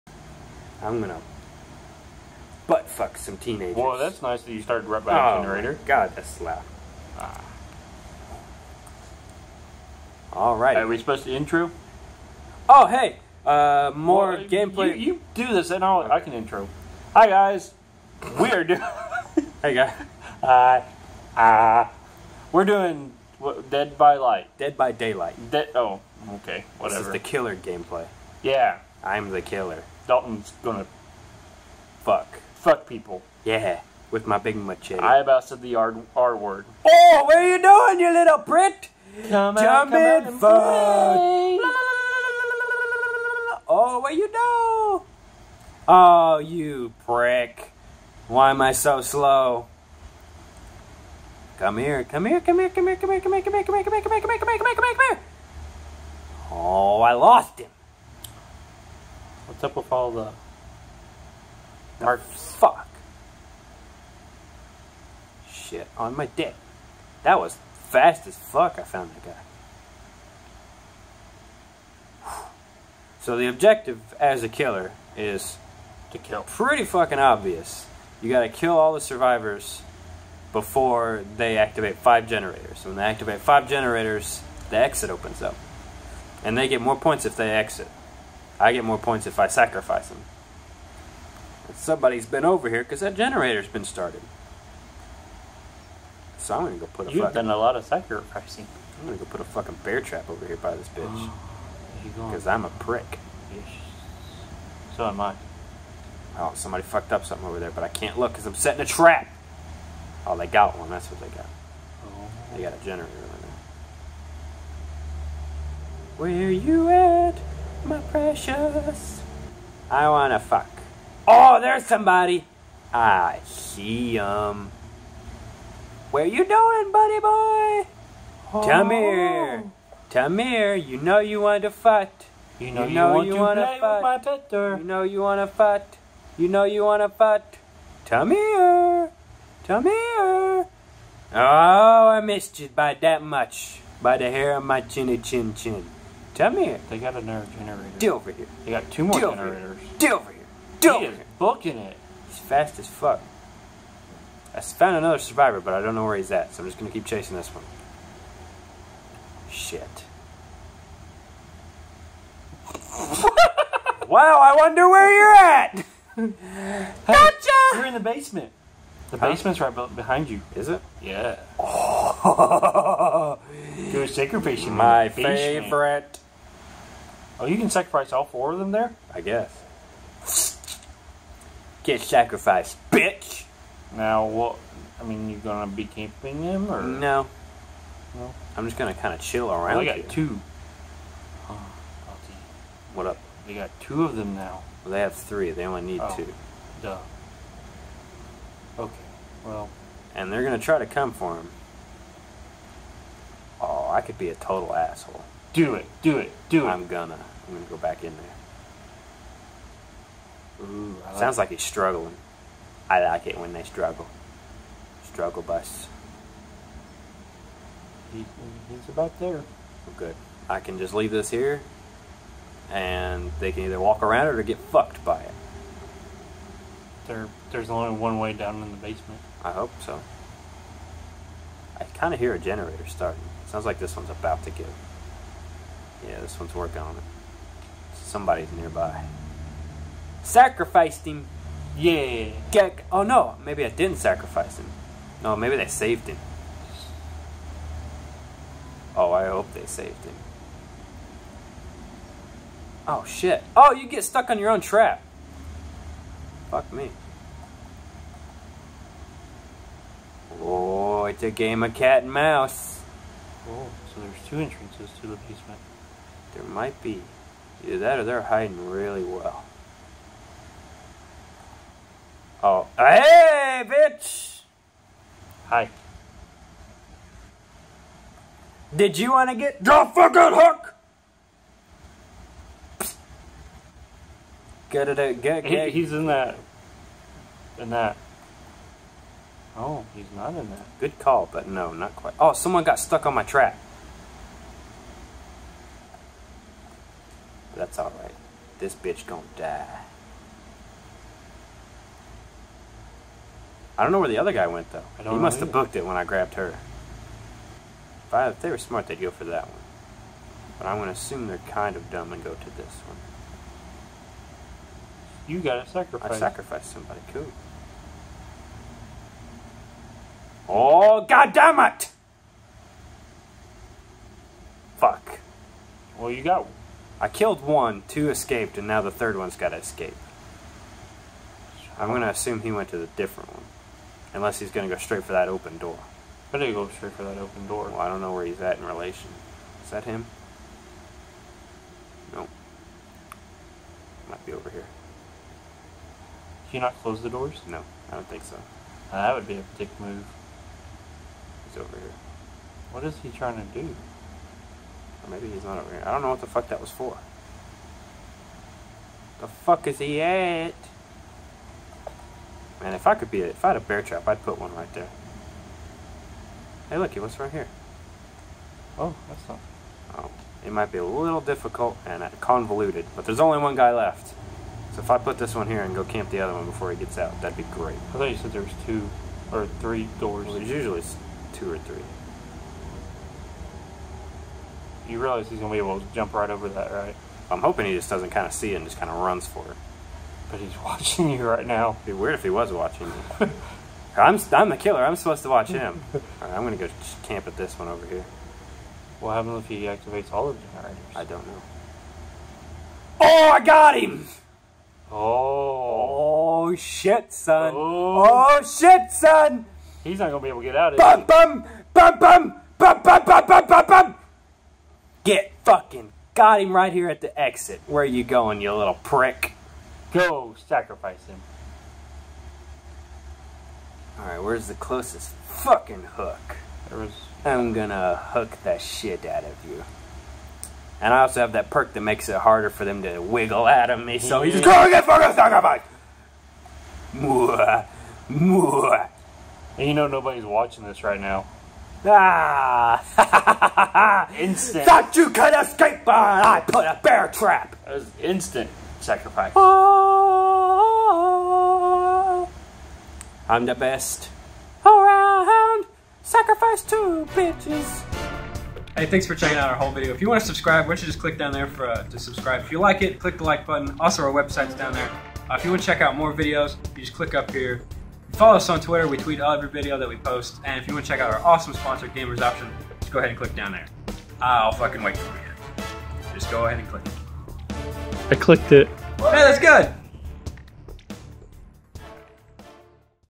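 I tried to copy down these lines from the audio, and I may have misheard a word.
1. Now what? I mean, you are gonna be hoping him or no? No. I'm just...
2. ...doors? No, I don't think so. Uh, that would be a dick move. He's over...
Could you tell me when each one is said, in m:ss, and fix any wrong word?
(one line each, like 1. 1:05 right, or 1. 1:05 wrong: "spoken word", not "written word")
1. 3:03 wrong: "camping", not "hoping"
2. 5:47 right.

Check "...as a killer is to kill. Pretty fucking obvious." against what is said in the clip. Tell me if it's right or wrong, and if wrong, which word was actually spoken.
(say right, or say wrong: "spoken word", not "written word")
right.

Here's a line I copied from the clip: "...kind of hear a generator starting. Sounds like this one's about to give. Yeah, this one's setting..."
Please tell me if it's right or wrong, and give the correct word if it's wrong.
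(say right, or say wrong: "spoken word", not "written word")
wrong: "working", not "setting".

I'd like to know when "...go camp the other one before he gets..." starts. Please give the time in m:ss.
6:15.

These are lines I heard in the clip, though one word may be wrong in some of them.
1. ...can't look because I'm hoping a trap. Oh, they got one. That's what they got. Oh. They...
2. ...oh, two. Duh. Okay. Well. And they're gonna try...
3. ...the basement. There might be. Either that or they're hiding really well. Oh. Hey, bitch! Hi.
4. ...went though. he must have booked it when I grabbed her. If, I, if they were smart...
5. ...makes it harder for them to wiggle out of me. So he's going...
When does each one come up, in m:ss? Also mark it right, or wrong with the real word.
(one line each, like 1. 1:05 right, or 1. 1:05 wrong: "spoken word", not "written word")
1. 1:47 wrong: "setting", not "hoping"
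2. 3:16 right
3. 4:25 right
4. 5:04 right
5. 7:11 right.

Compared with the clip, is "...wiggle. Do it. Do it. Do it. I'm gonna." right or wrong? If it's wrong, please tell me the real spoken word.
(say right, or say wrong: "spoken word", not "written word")
wrong: "asshole", not "wiggle".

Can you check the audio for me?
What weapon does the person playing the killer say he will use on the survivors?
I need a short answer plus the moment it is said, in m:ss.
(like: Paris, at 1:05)
machete, at 0:34.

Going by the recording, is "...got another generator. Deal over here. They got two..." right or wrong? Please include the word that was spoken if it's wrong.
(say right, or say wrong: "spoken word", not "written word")
right.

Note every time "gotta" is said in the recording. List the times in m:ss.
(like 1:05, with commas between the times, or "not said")
1:18, 5:15, 5:29.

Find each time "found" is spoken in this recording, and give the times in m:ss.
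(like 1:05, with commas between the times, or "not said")
1:08, 2:34.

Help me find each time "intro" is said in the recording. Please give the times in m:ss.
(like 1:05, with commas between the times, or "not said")
0:11, 0:16.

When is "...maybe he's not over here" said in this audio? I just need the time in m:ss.
5:55.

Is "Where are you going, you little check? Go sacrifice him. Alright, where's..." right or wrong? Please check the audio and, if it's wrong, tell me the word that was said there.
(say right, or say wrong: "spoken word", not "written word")
wrong: "prick", not "check".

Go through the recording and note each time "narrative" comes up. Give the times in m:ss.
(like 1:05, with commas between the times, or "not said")
not said.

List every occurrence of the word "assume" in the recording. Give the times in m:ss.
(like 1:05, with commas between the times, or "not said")
5:10, 5:32.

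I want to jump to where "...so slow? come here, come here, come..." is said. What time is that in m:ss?
0:48.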